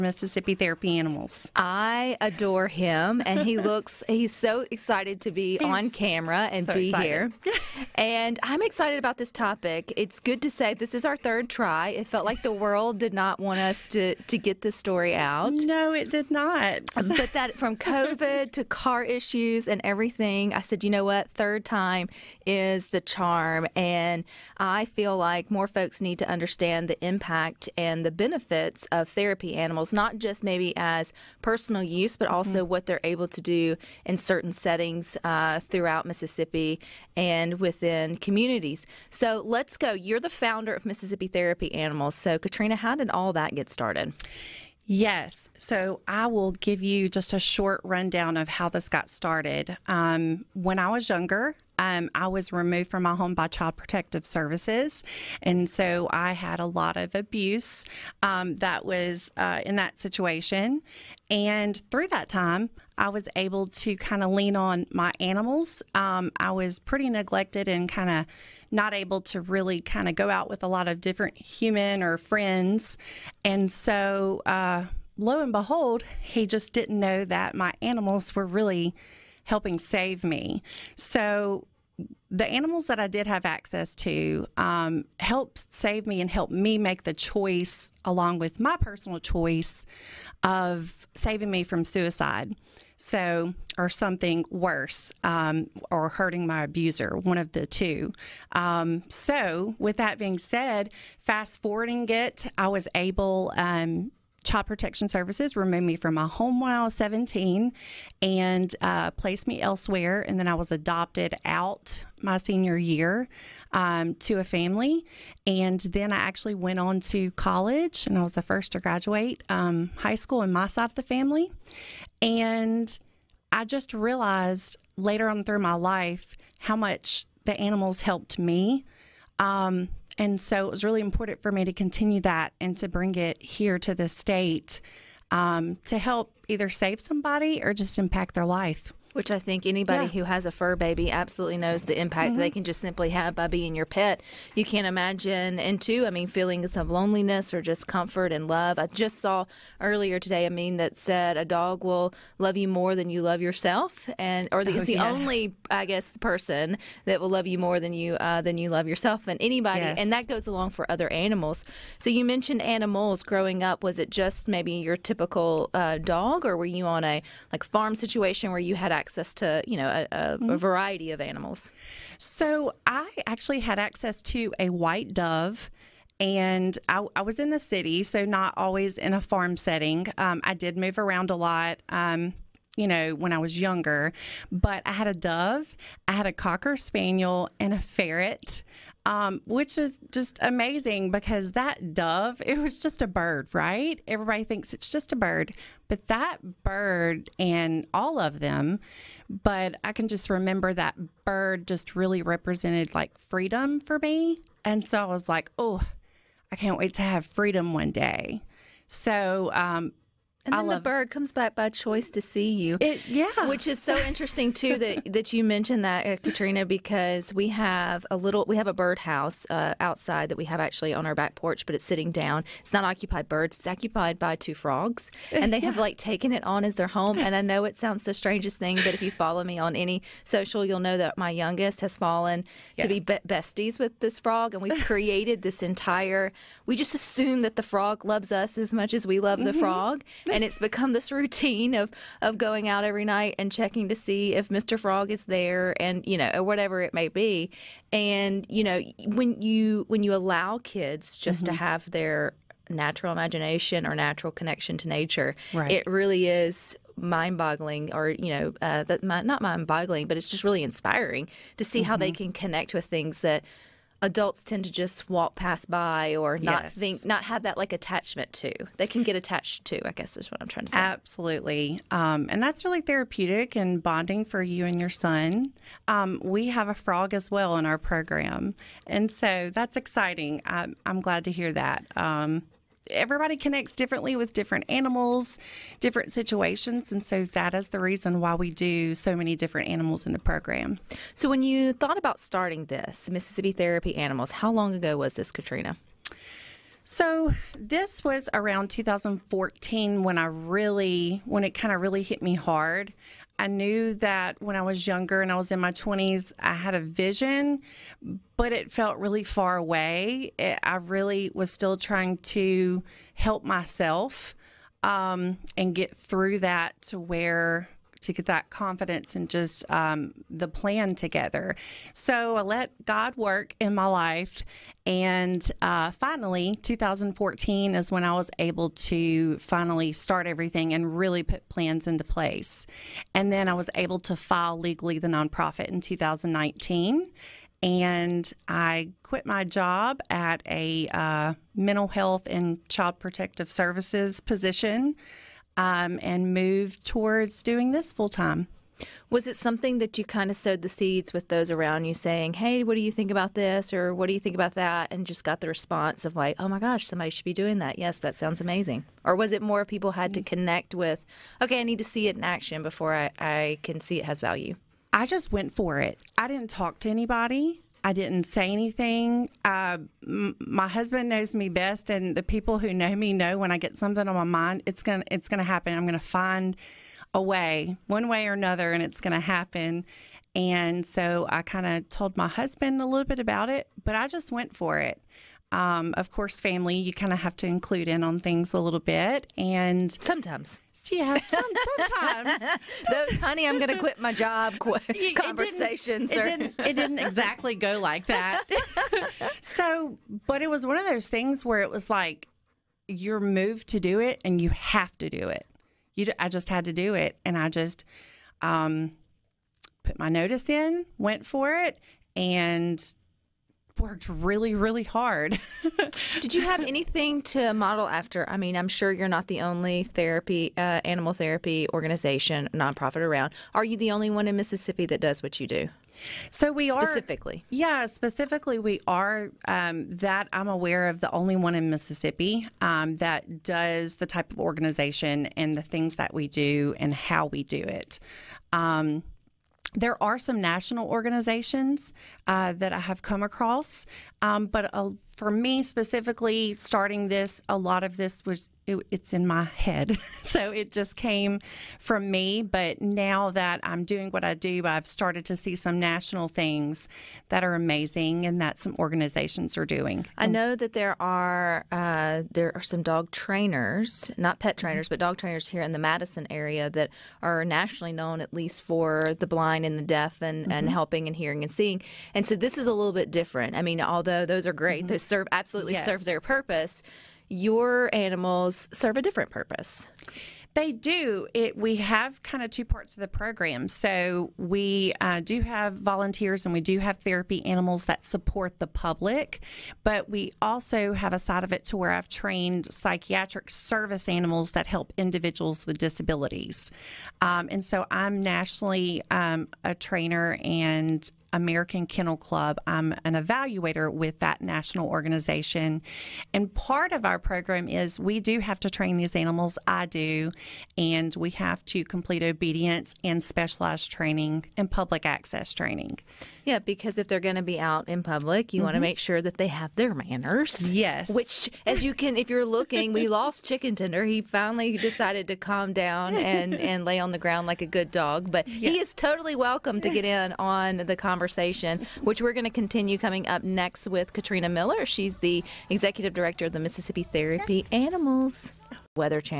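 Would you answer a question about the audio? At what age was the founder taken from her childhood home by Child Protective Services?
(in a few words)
17.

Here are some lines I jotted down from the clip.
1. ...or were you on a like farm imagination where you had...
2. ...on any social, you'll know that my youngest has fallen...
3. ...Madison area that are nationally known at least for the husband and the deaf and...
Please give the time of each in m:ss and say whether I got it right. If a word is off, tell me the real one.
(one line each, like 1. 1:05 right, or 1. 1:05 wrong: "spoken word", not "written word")
1. 2:46 wrong: "situation", not "imagination"
2. 3:49 right
3. 7:45 wrong: "blind", not "husband".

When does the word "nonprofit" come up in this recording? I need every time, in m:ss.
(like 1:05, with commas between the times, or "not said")
5:35, 7:02.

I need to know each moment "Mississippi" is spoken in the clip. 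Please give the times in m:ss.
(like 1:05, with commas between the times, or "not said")
0:36, 0:40, 4:53, 7:04, 7:11, 8:56.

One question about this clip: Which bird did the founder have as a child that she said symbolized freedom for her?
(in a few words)
White dove.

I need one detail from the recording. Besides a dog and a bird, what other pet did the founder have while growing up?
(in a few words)
Ferret.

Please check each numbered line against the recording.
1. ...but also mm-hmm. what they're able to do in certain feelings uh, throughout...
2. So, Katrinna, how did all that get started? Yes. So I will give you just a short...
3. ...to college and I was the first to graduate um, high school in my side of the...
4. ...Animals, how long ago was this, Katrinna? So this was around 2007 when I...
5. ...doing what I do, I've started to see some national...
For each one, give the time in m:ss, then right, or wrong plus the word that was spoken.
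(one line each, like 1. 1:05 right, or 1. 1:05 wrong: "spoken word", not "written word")
1. 0:32 wrong: "settings", not "feelings"
2. 0:42 right
3. 1:57 right
4. 4:53 wrong: "2014", not "2007"
5. 7:33 right.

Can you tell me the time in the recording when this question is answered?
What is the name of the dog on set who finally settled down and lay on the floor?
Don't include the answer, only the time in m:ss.
8:43.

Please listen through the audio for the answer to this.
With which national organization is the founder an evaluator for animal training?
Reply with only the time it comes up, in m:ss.
8:21.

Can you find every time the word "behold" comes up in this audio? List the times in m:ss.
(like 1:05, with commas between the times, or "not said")
1:15.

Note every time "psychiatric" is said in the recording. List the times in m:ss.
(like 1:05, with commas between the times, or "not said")
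8:12.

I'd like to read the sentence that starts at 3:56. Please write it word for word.
We just assume that the frog loves us as much as we love mm-hmm.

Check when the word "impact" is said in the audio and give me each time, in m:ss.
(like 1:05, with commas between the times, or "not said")
0:27, 2:17, 2:21.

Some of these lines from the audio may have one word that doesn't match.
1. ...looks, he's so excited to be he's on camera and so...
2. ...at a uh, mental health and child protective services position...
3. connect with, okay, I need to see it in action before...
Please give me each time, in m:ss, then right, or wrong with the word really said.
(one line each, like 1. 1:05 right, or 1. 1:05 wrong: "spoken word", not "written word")
1. 0:03 right
2. 5:40 right
3. 6:00 right.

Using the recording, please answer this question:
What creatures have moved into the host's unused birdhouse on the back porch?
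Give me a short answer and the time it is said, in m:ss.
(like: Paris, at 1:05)
Two frogs, at 3:44.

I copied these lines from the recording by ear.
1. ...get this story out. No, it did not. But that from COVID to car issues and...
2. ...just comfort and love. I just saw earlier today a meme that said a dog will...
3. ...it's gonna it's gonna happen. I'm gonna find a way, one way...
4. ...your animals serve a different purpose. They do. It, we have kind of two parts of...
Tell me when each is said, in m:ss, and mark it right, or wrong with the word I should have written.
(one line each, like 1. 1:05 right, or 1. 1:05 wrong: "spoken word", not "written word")
1. 0:14 right
2. 2:27 right
3. 6:14 right
4. 7:57 right.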